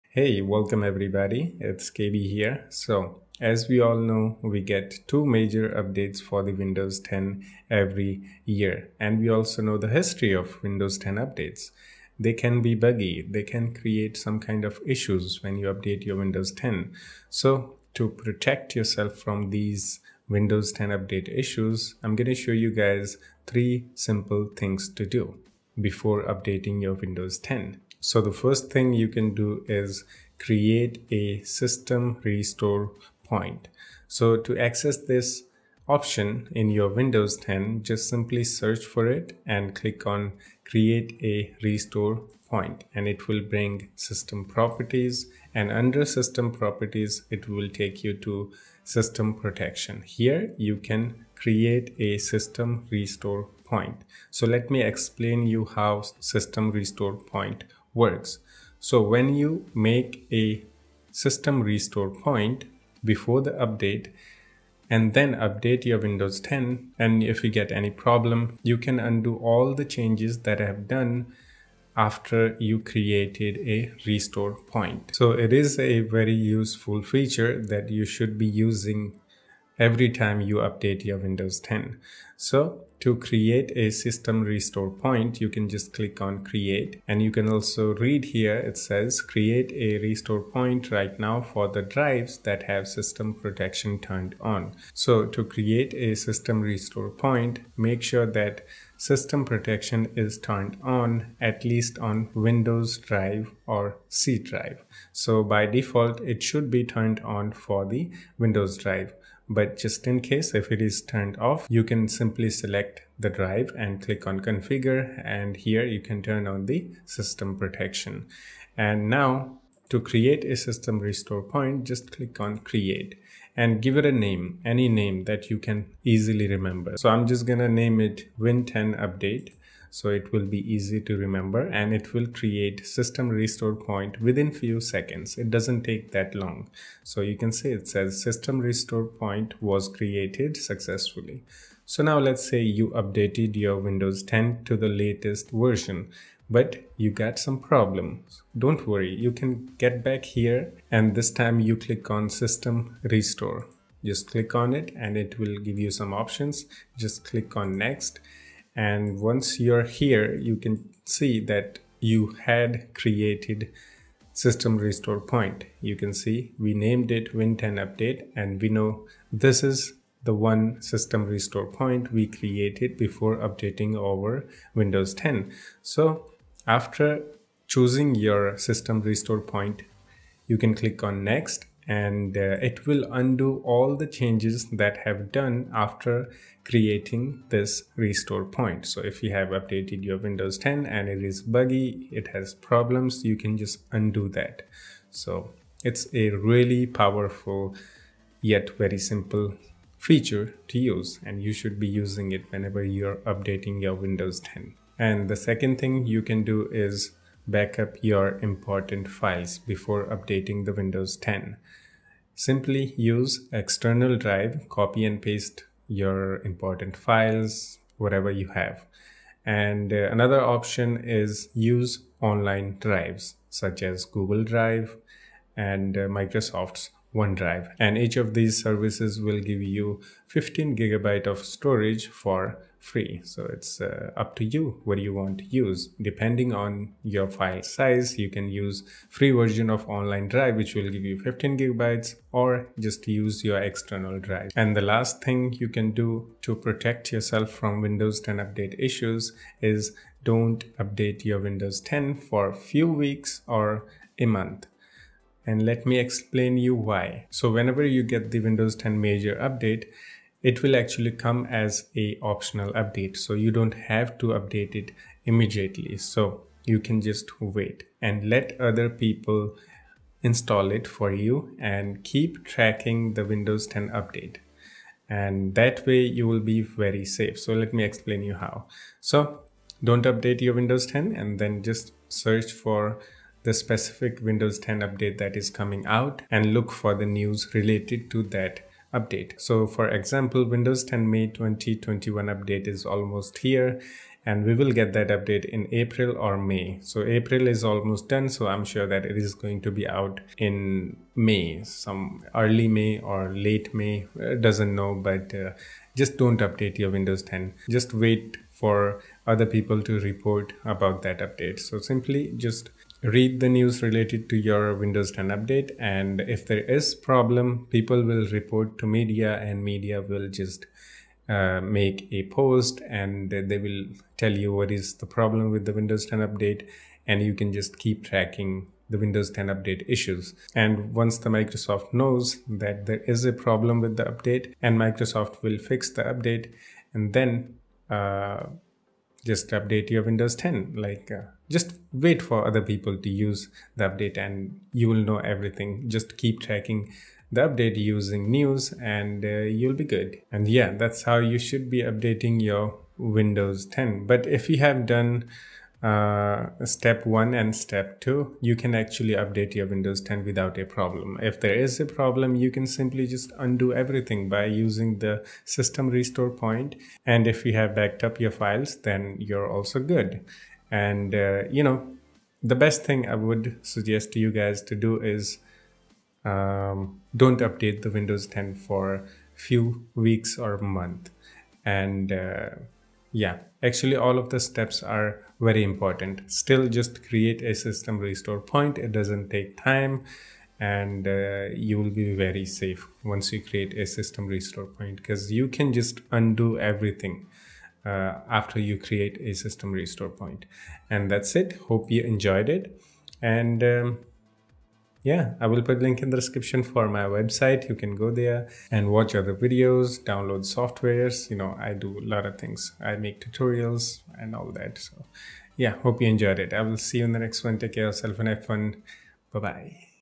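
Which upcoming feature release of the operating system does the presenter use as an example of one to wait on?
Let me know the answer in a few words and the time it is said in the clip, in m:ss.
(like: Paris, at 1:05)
May 2021 update, at 4:51.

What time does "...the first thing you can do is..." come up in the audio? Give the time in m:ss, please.
0:28.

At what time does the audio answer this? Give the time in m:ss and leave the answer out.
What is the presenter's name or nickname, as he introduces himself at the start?
0:01.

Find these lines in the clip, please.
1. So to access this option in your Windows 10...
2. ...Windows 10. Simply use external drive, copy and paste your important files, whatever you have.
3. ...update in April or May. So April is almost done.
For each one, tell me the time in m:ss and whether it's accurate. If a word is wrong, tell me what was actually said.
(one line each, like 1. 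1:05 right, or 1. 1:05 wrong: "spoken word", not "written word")
1. 0:34 right
2. 3:30 right
3. 4:55 right.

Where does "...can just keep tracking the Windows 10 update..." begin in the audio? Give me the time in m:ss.
5:27.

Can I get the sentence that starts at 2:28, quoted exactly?
Don't worry, you can get back here and this time you click on system restore.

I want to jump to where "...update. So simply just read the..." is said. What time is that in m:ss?
5:11.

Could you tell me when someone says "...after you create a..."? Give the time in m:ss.
6:38.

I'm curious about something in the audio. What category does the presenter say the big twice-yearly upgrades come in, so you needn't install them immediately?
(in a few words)
optional update.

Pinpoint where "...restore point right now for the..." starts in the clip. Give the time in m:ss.
1:29.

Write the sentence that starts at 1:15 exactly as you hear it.
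So it is a very useful feature that you should be using every time you update your Windows 10.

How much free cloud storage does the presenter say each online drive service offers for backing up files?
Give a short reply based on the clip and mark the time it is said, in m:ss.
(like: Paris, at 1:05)
15 gigabytes, at 3:50.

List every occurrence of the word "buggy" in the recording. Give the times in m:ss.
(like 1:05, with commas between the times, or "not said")
0:12, 3:11.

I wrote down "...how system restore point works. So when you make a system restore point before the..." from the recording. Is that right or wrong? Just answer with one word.
right.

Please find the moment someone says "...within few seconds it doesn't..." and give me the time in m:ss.
2:14.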